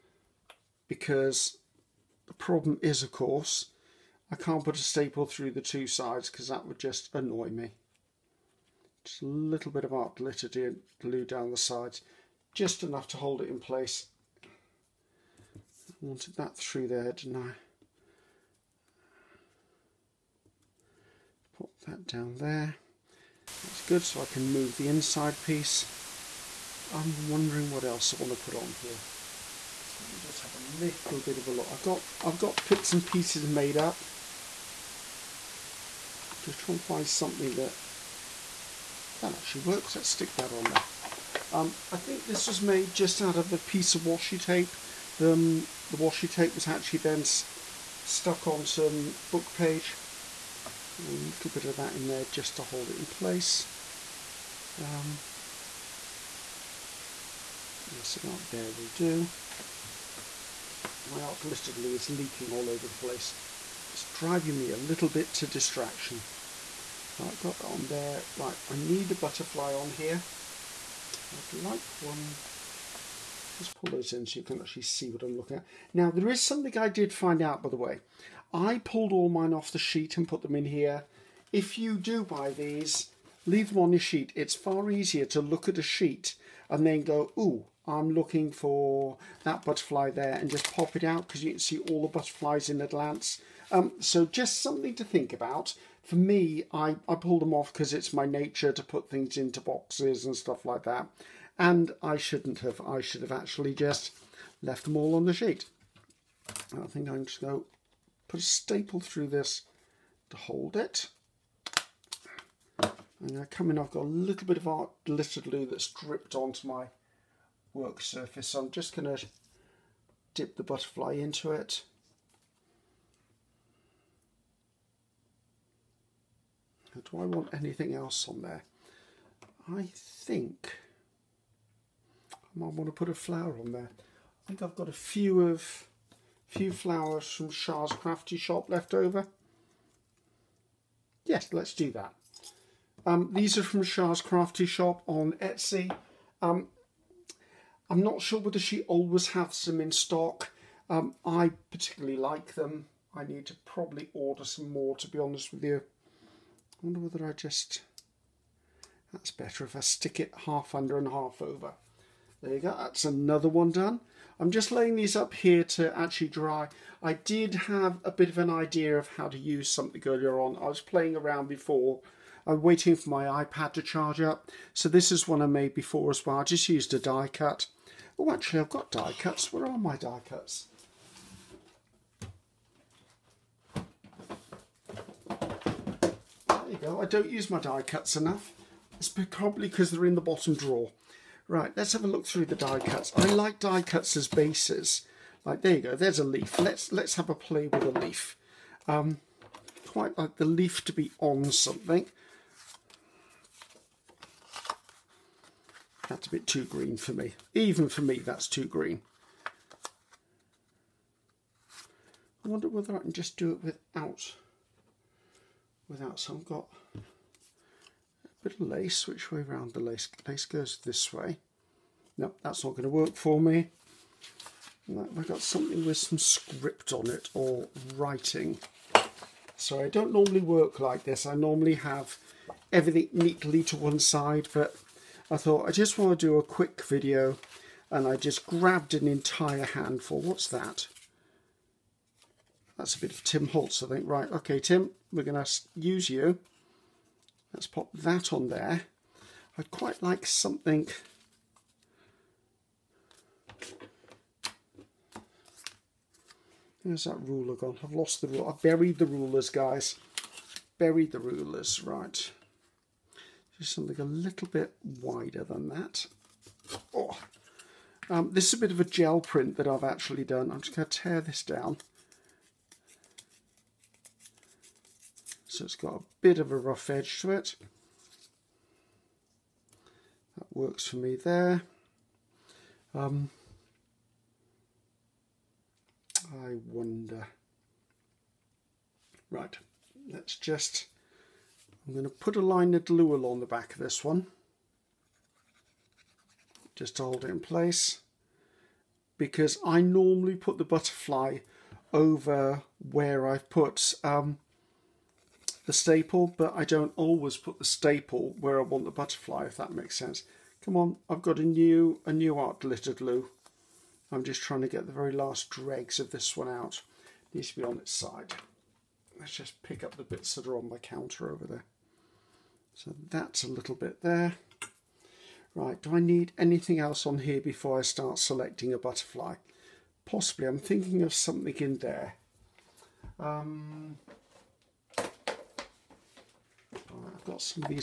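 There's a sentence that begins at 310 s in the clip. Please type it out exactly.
Come on, I've got a new, a new art glitter glue.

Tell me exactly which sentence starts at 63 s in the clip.
It's driving me a little bit to distraction.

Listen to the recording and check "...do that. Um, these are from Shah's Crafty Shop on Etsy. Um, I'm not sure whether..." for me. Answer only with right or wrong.
right.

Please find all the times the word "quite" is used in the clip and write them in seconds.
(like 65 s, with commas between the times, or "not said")
199 s, 249 s.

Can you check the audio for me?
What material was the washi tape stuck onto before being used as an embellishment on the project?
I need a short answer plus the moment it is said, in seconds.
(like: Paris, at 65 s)
Book page, at 49 s.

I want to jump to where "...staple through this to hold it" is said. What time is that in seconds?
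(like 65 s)
108 s.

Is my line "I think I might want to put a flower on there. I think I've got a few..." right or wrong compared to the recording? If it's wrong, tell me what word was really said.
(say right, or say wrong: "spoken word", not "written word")
right.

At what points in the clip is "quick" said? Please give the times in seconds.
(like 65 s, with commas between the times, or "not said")
236 s.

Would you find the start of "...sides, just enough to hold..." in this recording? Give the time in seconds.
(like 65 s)
11 s.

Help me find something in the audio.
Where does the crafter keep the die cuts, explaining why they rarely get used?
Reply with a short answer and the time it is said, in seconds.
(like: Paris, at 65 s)
Bottom drawer, at 190 s.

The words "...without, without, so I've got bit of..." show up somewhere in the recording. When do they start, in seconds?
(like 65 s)
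213 s.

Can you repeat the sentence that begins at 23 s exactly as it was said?
That's good, so I can move the inside piece.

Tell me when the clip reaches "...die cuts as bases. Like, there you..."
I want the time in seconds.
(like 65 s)
193 s.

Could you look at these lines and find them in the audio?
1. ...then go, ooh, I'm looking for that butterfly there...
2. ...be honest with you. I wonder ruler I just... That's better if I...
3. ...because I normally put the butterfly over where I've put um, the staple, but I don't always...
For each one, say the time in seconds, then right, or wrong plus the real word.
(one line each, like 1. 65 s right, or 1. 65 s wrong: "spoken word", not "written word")
1. 86 s right
2. 155 s wrong: "whether", not "ruler"
3. 299 s right.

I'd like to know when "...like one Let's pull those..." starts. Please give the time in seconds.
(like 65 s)
71 s.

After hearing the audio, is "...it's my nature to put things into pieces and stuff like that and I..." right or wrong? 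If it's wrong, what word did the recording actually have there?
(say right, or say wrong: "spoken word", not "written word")
wrong: "boxes", not "pieces".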